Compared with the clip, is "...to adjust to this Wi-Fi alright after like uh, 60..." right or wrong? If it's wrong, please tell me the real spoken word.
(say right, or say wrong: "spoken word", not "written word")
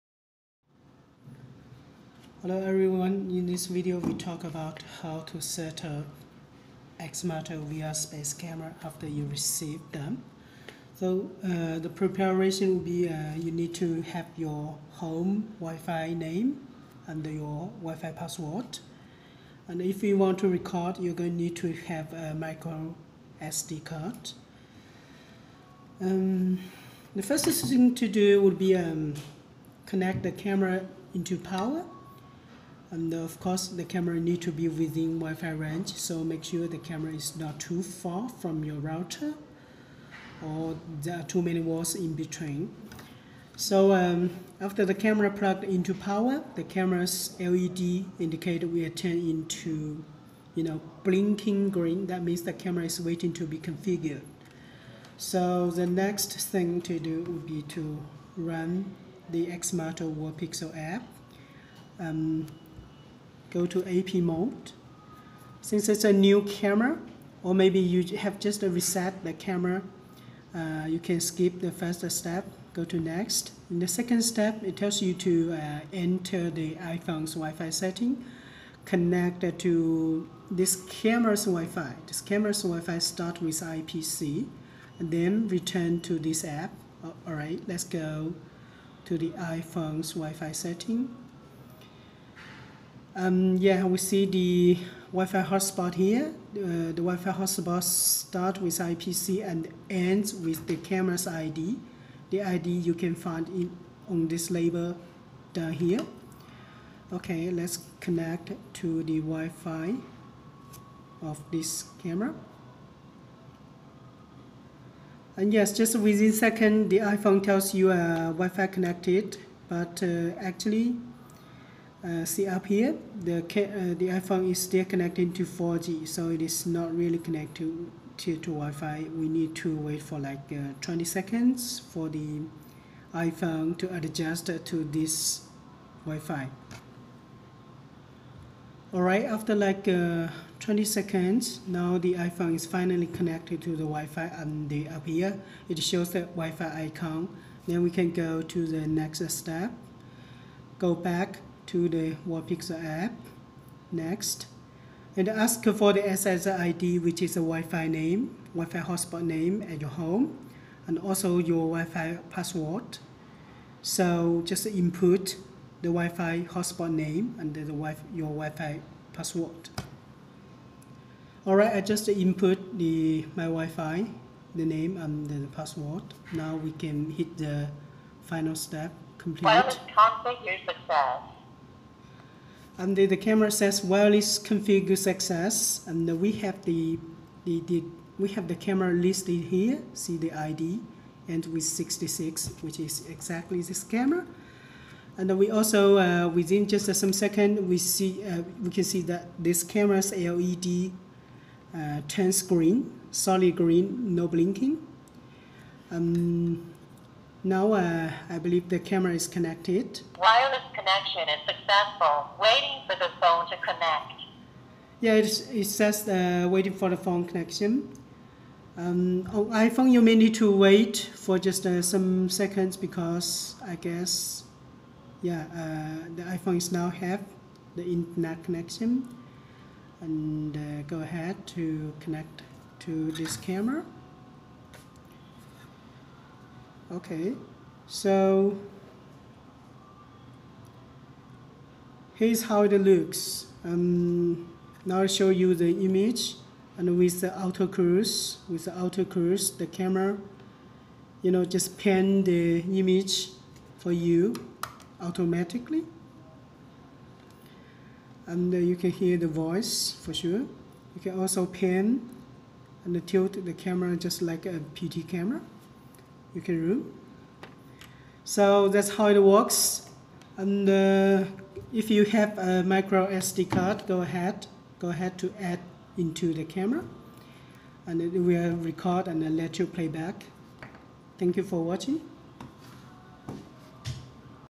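wrong: "20", not "60".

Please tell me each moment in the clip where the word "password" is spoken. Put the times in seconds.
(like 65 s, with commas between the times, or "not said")
18 s, 162 s, 169 s, 175 s.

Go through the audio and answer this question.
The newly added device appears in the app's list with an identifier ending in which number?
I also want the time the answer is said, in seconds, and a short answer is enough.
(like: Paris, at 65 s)
66, at 191 s.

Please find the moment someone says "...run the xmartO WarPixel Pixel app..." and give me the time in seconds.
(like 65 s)
58 s.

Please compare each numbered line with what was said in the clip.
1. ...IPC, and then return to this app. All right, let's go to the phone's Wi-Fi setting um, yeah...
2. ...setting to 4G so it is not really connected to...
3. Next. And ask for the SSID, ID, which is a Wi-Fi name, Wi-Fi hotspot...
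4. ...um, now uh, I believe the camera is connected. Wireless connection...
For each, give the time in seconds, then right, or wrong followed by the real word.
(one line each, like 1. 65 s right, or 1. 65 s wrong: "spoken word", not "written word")
1. 83 s wrong: "iPhone", not "phone"
2. 124 s wrong: "connecting", not "setting"
3. 153 s right
4. 205 s right.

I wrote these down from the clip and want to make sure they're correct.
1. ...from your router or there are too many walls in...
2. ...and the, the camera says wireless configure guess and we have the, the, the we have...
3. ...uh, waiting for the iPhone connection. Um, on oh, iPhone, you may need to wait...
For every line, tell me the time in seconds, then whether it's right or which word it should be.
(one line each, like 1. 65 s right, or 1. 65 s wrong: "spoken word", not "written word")
1. 38 s right
2. 182 s wrong: "success", not "guess"
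3. 216 s wrong: "phone", not "iPhone".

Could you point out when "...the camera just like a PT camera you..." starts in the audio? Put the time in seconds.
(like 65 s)
263 s.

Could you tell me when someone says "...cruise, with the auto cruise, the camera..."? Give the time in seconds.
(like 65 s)
247 s.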